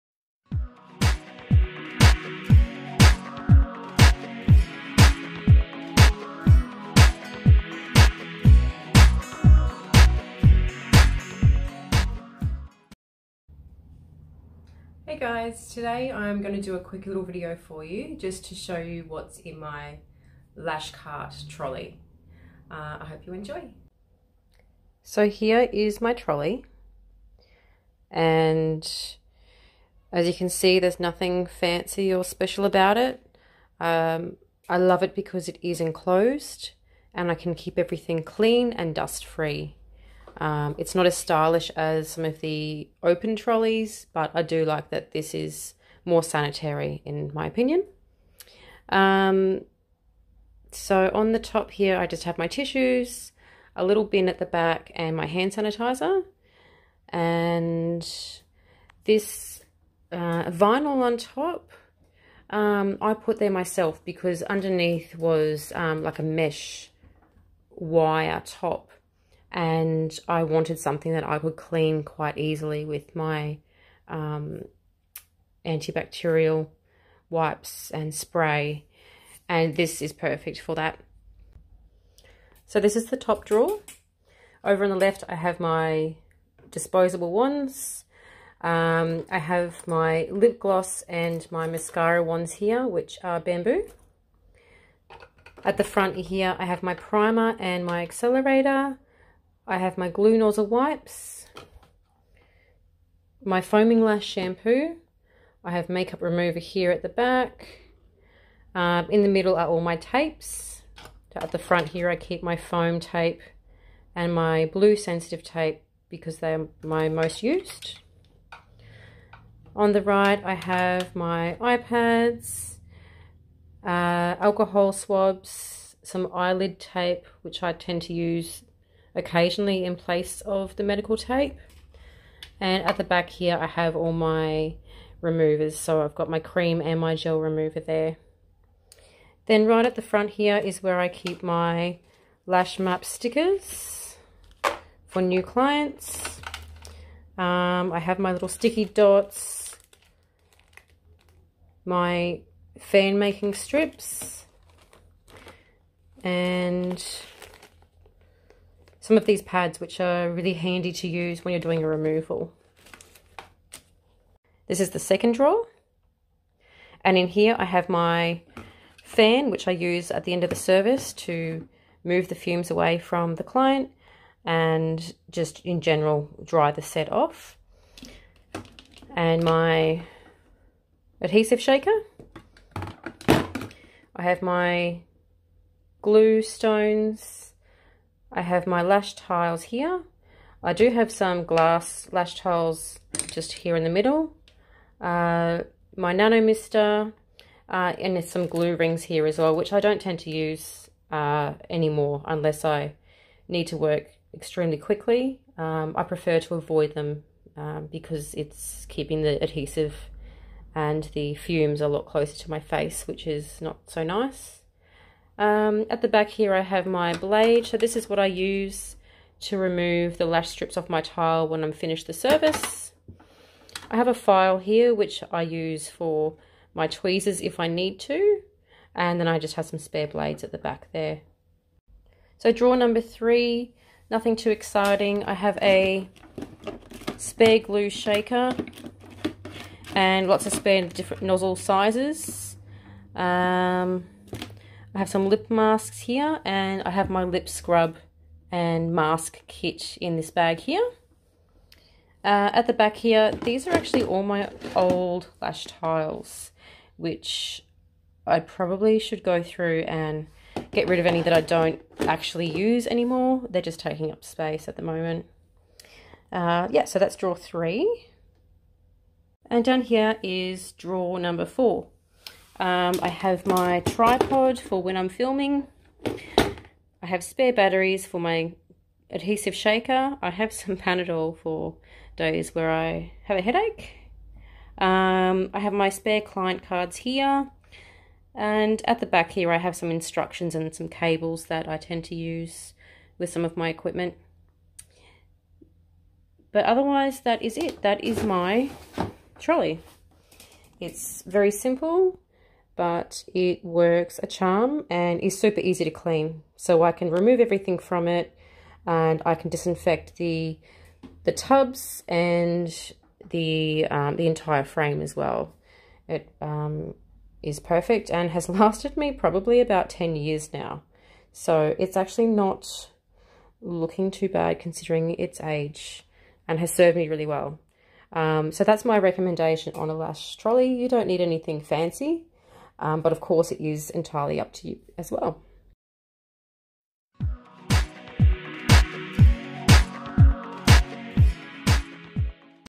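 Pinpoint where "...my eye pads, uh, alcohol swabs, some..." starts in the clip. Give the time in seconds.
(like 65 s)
121 s.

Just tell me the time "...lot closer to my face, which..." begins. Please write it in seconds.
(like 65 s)
211 s.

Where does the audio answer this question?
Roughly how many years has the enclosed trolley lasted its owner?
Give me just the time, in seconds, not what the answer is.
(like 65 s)
319 s.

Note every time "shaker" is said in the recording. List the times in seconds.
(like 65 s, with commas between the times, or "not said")
181 s, 237 s, 279 s.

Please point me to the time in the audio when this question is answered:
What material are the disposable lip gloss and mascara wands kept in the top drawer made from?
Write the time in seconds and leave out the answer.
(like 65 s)
93 s.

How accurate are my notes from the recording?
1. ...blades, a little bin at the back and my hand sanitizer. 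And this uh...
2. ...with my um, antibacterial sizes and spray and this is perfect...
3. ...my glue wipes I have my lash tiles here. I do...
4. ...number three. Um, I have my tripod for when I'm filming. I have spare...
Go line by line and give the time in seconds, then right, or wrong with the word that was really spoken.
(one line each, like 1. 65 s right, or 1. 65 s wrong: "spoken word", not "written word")
1. 52 s wrong: "tissues", not "blades"
2. 72 s wrong: "wipes", not "sizes"
3. 184 s wrong: "stones", not "wipes"
4. 271 s wrong: "four", not "three".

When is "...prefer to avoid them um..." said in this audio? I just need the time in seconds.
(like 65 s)
206 s.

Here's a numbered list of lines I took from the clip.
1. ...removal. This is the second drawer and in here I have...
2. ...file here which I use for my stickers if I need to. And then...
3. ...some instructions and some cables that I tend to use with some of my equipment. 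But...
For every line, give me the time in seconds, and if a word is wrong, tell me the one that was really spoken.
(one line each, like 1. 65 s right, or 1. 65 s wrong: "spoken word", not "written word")
1. 161 s right
2. 224 s wrong: "tweezers", not "stickers"
3. 289 s right.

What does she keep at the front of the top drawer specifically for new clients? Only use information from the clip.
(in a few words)
Lash map stickers.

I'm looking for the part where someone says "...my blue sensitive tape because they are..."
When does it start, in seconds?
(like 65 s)
114 s.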